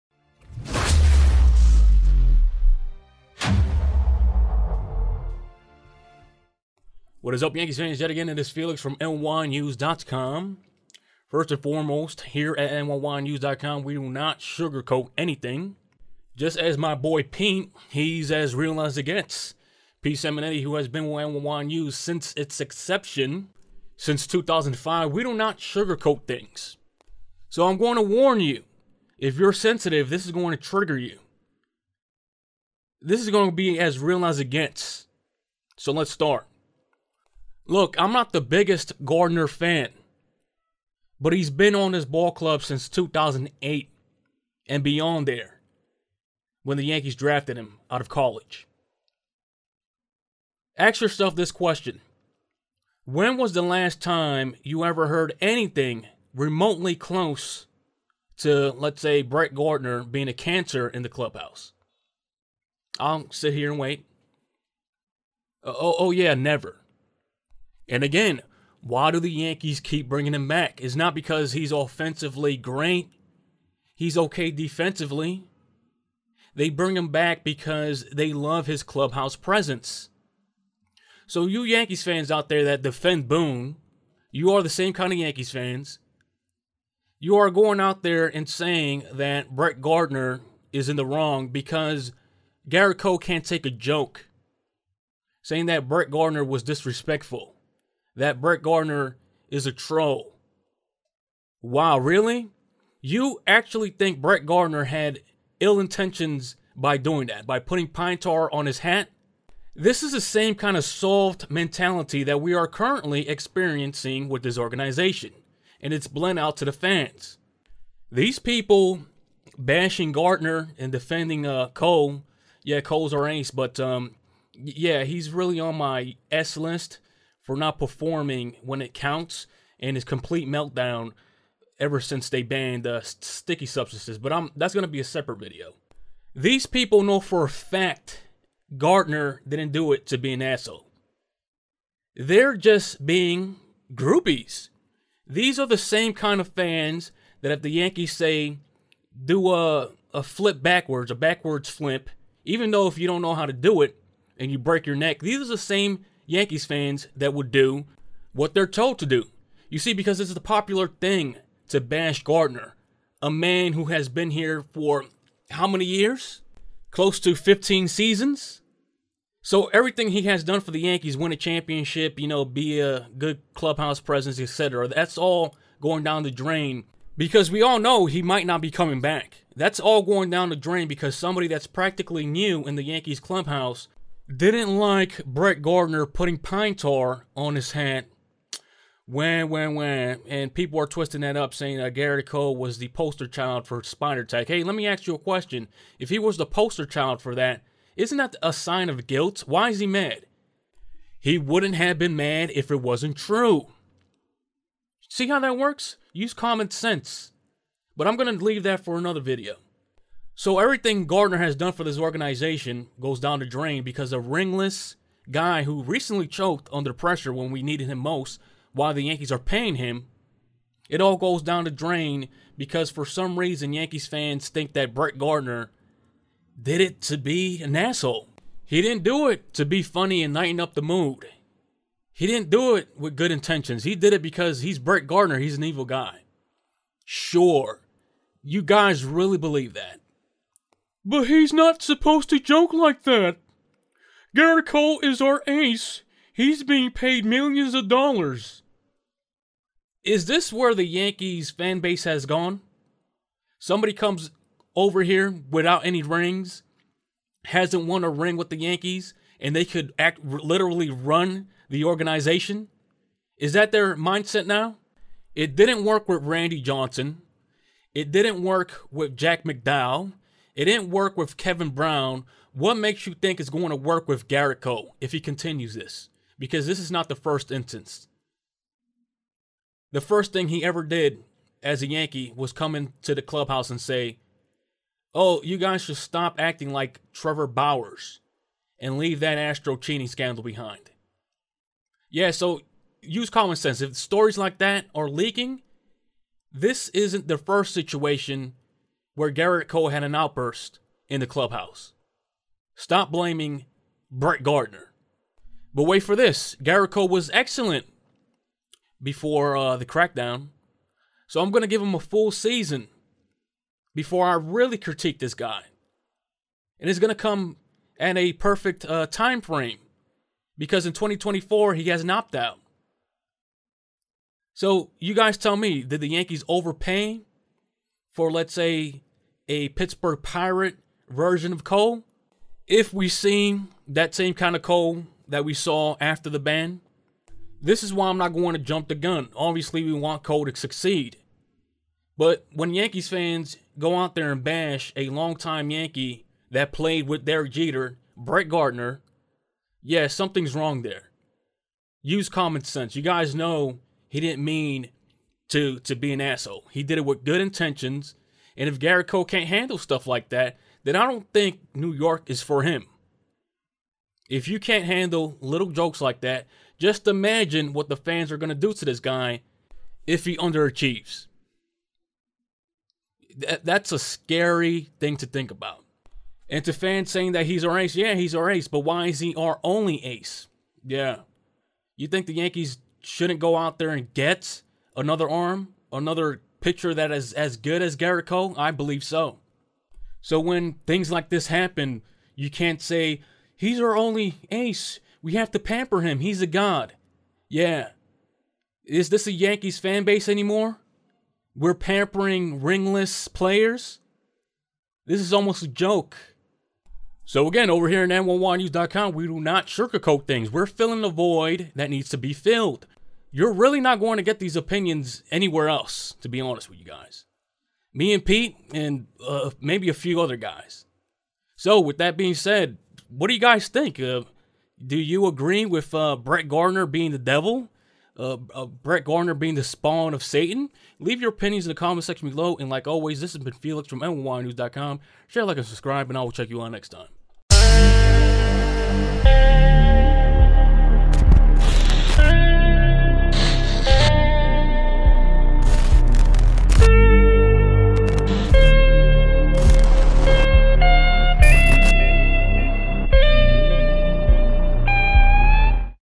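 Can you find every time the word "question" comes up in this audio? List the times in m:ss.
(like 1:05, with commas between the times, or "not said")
0:51, 3:15.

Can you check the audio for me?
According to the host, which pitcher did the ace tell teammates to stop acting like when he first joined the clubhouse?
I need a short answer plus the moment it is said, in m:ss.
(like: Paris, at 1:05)
Trevor Bauer, at 4:47.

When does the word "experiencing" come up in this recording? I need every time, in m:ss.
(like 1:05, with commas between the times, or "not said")
1:53.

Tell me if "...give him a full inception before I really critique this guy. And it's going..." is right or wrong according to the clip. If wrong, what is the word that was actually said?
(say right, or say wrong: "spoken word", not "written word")
wrong: "season", not "inception".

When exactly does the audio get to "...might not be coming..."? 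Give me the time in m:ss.
2:58.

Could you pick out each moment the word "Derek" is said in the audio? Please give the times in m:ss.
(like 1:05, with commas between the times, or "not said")
5:47.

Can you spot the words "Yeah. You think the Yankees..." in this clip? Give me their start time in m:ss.
6:20.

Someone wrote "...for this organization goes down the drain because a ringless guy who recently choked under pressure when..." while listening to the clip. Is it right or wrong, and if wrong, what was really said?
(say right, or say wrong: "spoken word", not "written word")
right.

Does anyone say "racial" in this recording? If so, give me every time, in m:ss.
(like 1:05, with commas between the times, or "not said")
not said.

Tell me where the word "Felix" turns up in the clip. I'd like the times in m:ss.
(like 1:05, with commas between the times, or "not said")
0:08, 7:13.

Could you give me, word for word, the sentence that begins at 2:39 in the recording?
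You see, because it's the popular thing to bash Gardner, a man who has been here for how many years?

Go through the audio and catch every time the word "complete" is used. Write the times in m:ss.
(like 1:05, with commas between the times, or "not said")
2:10.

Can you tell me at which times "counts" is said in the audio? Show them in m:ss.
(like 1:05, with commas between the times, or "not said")
2:08.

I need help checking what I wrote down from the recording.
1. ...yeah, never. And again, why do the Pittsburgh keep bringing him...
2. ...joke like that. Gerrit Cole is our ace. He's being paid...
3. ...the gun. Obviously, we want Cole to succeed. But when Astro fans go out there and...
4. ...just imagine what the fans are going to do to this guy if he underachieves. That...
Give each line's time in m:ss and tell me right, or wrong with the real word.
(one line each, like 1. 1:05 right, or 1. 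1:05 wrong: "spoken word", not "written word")
1. 1:06 wrong: "Yankees", not "Pittsburgh"
2. 4:02 right
3. 5:38 wrong: "Yankees", not "Astro"
4. 6:06 right.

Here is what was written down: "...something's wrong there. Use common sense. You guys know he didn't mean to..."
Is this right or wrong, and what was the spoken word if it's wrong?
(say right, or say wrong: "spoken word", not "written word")
right.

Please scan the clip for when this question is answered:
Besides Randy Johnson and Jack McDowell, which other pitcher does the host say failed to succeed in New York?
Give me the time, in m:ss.
4:31.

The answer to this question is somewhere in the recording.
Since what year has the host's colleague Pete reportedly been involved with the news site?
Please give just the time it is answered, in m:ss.
0:24.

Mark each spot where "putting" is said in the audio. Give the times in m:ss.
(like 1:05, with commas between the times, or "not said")
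1:47, 3:06.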